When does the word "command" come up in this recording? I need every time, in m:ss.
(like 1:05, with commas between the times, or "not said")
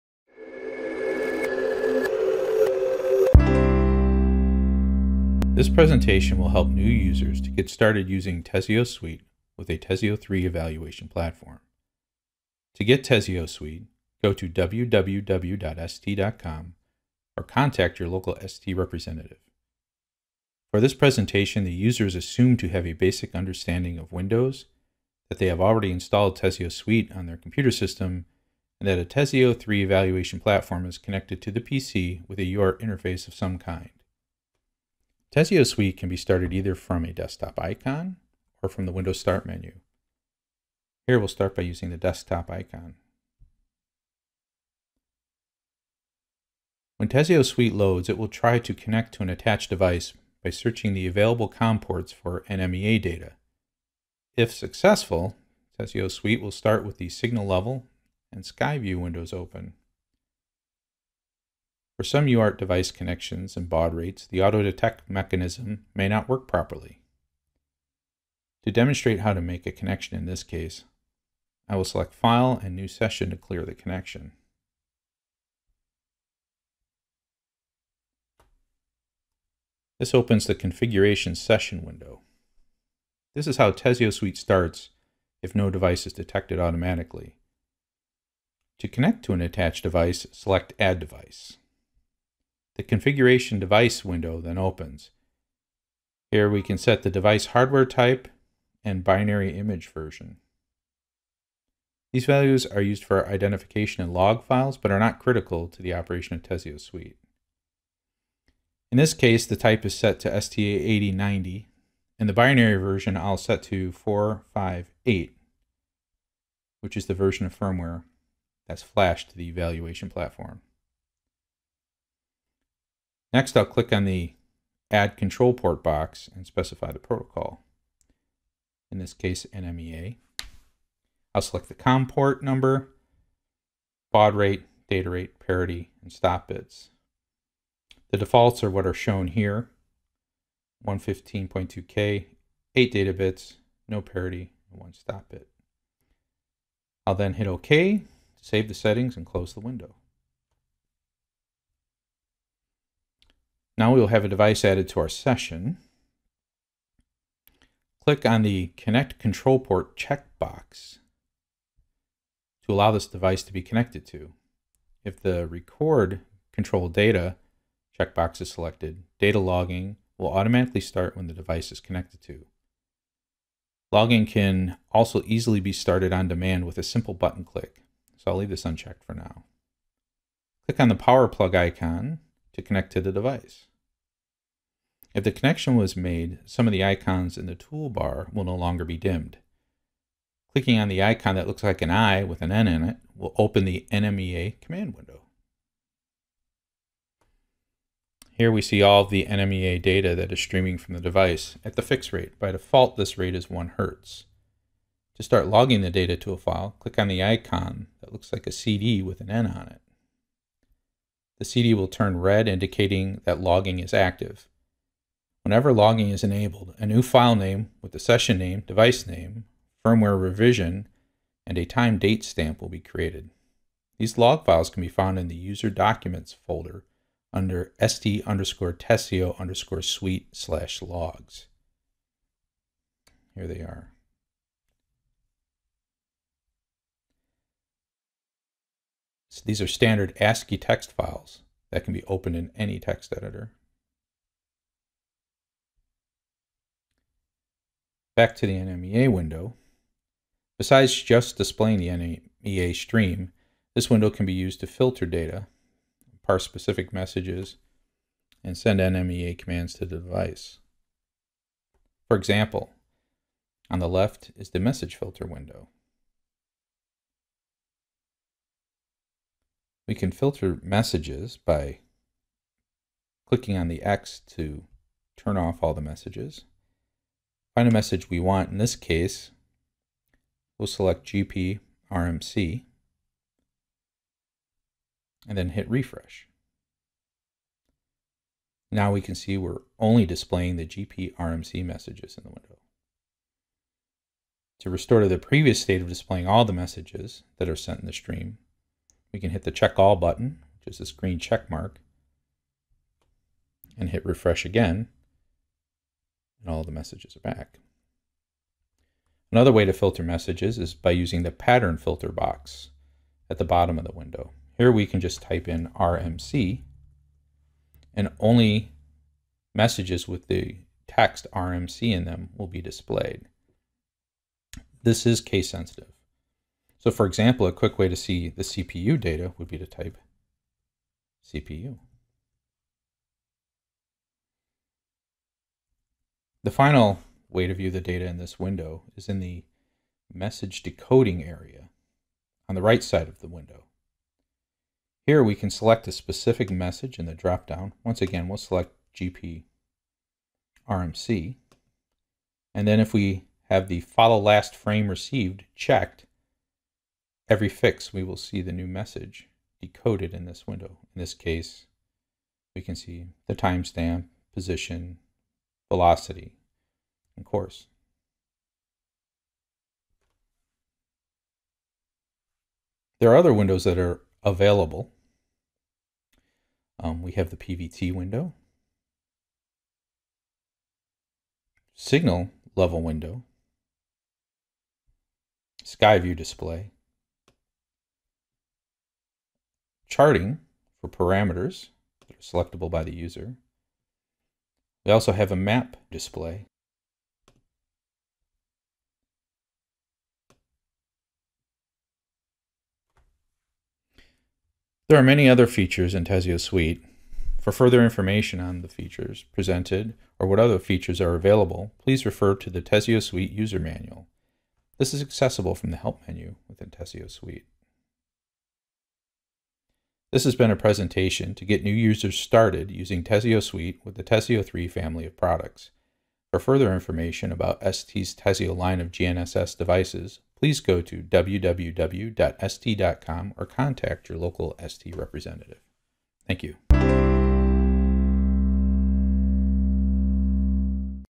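3:14, 4:19.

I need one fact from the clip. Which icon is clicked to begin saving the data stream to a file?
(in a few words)
CD with an N.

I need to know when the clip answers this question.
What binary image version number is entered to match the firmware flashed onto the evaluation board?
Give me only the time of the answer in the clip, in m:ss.
1:53.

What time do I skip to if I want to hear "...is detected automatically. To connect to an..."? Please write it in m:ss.
1:26.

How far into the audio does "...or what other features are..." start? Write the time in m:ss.
6:50.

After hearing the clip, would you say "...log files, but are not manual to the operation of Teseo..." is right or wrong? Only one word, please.
wrong.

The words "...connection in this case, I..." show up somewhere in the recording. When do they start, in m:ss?
1:09.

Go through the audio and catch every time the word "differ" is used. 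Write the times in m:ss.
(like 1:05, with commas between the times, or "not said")
not said.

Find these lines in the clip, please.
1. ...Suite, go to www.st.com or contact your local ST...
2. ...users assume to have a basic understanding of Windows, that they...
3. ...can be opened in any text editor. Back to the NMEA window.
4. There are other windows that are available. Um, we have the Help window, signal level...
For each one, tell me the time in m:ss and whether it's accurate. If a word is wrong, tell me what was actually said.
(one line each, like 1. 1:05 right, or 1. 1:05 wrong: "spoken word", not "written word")
1. 0:13 right
2. 0:21 right
3. 4:01 right
4. 6:12 wrong: "PVT", not "Help".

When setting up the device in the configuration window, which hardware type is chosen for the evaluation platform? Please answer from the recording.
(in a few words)
STA8090.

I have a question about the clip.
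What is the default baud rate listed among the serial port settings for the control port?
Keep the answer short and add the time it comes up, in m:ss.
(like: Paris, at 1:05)
115.2K, at 2:20.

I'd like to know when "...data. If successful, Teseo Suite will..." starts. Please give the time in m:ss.
0:53.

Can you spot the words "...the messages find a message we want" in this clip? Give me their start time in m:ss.
4:35.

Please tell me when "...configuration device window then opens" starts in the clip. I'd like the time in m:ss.
1:32.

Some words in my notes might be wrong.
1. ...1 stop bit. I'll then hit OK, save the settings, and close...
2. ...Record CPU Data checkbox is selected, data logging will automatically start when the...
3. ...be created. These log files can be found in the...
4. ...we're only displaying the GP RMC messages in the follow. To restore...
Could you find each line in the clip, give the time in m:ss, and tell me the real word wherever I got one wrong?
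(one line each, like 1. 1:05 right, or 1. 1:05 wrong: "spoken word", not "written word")
1. 2:24 right
2. 2:45 wrong: "Control", not "CPU"
3. 3:42 right
4. 4:49 wrong: "window", not "follow".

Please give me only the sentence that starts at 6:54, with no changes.
This is accessible from the Help menu within Teseo Suite.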